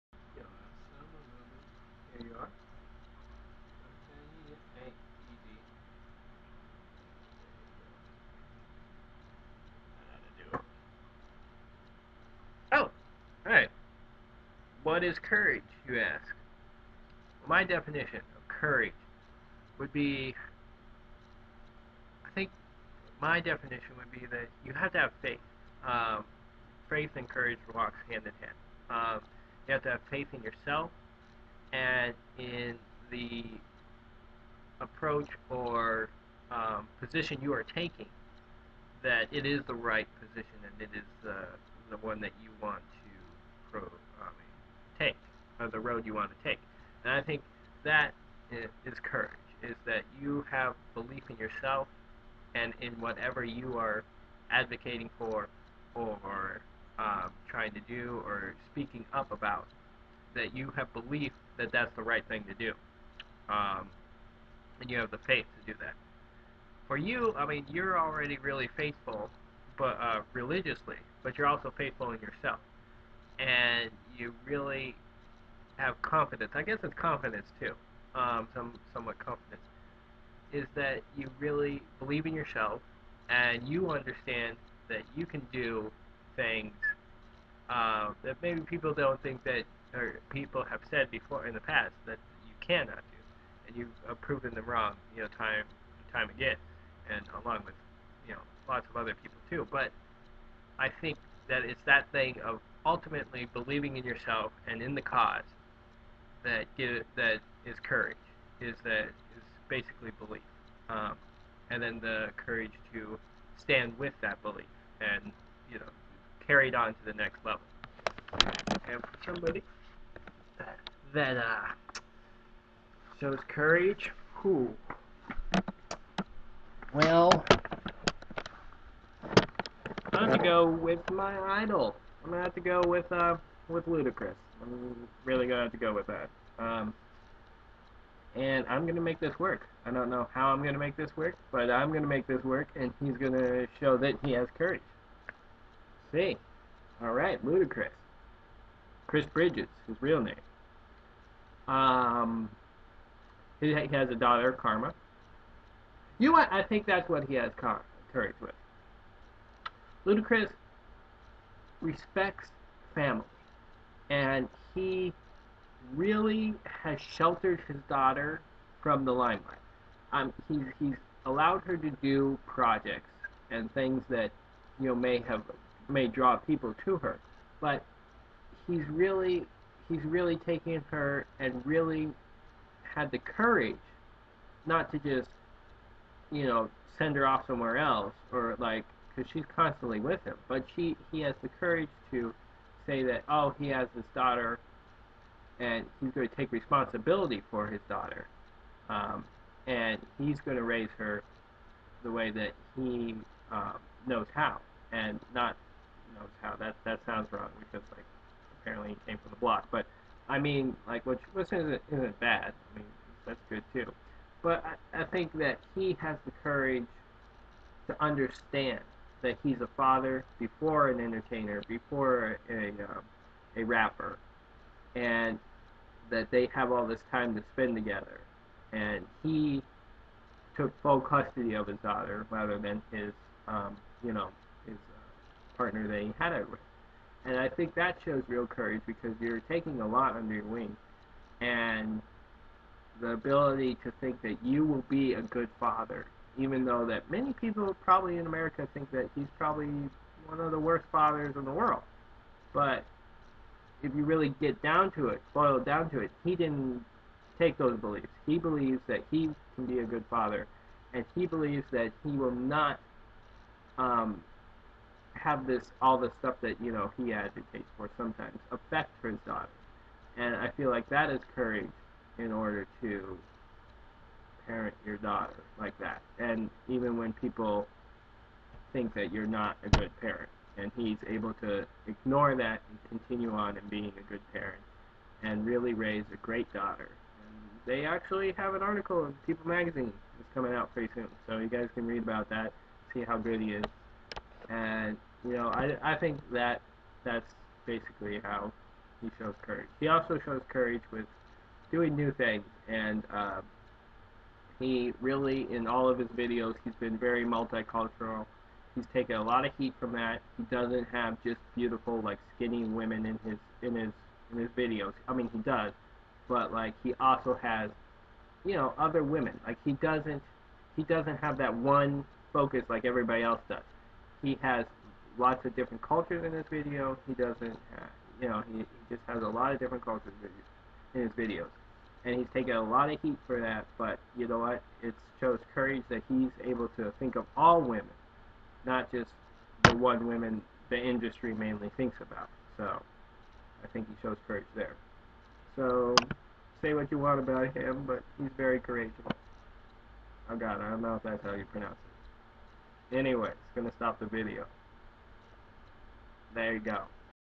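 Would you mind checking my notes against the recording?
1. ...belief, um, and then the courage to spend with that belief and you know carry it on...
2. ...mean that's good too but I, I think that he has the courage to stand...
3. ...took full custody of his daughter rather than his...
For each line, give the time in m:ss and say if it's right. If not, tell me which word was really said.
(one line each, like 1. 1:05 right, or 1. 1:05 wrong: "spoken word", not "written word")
1. 1:50 wrong: "stand", not "spend"
2. 3:32 wrong: "understand", not "stand"
3. 3:50 right.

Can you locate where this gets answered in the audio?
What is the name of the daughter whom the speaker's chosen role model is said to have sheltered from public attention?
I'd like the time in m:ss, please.
2:34.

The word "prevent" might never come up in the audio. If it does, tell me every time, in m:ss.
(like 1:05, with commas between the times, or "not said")
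not said.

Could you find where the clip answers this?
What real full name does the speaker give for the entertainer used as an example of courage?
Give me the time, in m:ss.
2:29.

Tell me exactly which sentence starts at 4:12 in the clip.
But if you really get down to it, boil down to it, he didn't take those beliefs.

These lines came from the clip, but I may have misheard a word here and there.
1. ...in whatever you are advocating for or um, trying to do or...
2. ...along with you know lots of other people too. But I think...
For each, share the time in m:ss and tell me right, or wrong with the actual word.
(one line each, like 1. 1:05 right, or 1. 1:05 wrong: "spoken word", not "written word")
1. 0:52 right
2. 1:37 right.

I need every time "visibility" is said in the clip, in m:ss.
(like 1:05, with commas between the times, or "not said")
not said.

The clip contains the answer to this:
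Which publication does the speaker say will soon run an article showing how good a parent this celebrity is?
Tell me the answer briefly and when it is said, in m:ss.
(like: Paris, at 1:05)
People Magazine, at 4:49.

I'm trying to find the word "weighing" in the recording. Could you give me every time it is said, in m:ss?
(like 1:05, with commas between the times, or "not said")
not said.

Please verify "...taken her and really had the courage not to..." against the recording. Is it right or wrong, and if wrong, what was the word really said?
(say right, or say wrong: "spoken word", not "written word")
right.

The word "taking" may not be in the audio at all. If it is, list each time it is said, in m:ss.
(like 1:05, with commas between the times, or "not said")
0:37, 3:59.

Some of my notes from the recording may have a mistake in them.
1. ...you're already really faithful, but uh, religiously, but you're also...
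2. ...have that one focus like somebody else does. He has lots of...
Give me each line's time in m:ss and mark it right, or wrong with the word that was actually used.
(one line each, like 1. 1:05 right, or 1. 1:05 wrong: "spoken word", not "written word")
1. 1:07 right
2. 5:21 wrong: "everybody", not "somebody".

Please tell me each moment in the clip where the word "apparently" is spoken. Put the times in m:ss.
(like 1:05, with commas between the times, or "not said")
3:28.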